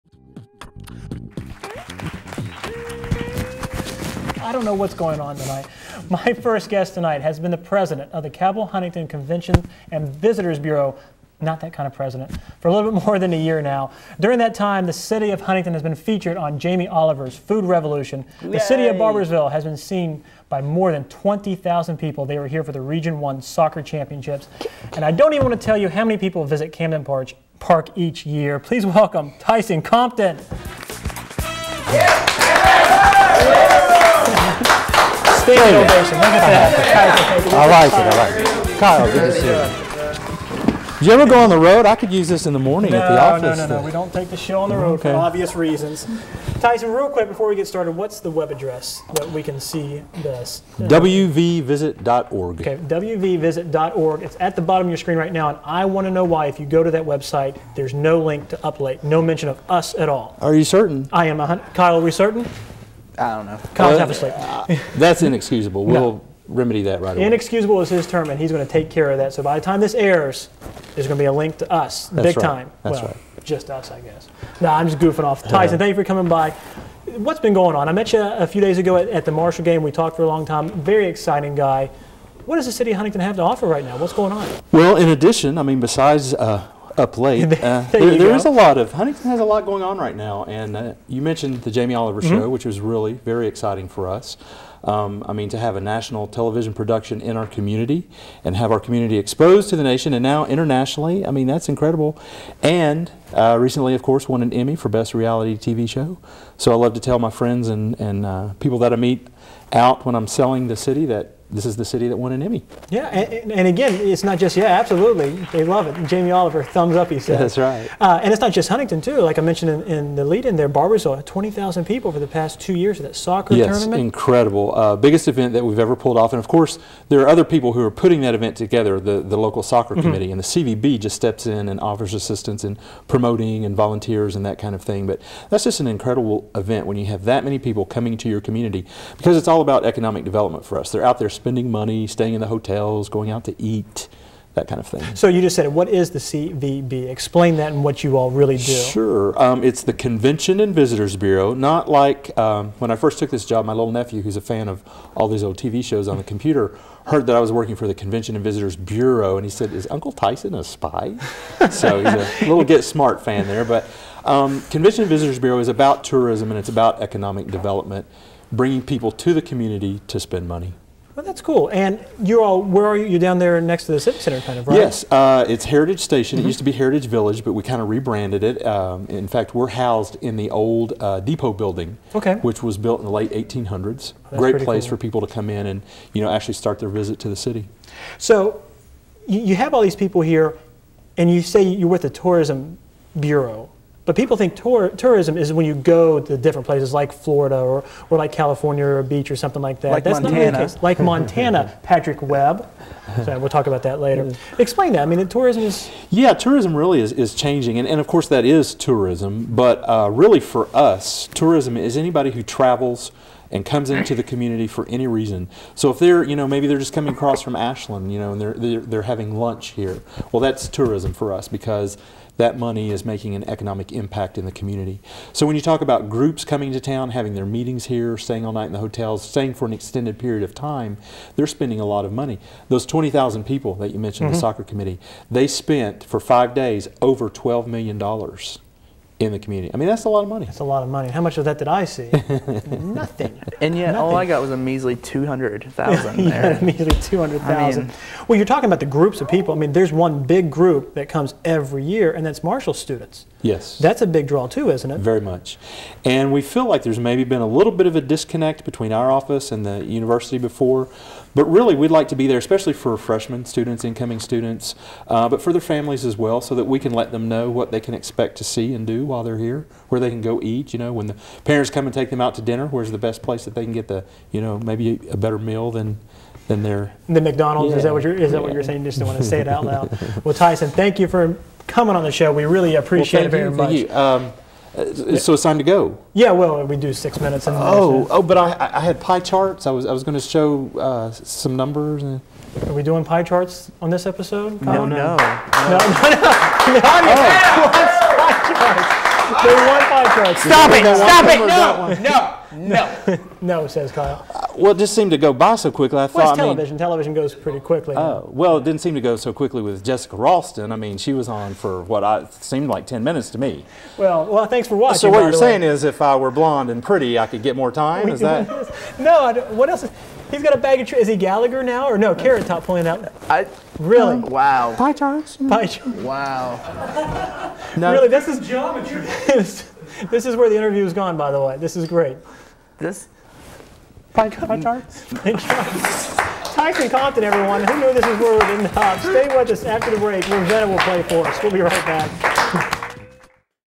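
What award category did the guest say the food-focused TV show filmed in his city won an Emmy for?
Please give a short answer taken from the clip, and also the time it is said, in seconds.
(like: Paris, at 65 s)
Best Reality TV Show, at 104 s.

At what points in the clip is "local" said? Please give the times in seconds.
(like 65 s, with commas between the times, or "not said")
129 s.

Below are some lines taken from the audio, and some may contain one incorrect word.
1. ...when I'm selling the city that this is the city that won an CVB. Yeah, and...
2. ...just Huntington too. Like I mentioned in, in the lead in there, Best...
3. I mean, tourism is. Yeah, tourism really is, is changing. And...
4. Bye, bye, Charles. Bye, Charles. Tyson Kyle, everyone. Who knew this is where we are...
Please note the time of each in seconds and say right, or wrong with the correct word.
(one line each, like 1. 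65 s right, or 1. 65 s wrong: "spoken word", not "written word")
1. 110 s wrong: "Emmy", not "CVB"
2. 118 s wrong: "Barboursville", not "Best"
3. 205 s right
4. 334 s wrong: "Compton", not "Kyle".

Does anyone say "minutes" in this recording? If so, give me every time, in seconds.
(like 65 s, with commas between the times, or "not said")
287 s, 313 s.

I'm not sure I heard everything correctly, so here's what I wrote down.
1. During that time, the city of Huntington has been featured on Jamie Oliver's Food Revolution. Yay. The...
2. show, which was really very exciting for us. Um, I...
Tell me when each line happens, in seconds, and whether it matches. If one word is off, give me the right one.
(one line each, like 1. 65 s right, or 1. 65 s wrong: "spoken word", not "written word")
1. 14 s right
2. 92 s right.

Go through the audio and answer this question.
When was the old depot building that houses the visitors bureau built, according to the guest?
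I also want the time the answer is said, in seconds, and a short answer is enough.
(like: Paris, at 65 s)
late 1800s, at 183 s.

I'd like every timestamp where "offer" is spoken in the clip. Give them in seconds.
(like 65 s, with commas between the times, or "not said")
83 s, 131 s.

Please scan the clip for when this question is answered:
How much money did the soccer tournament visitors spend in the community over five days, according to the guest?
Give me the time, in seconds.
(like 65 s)
237 s.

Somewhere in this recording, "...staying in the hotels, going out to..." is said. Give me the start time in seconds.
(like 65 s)
142 s.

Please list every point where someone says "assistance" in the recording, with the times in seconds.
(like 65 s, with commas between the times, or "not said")
132 s.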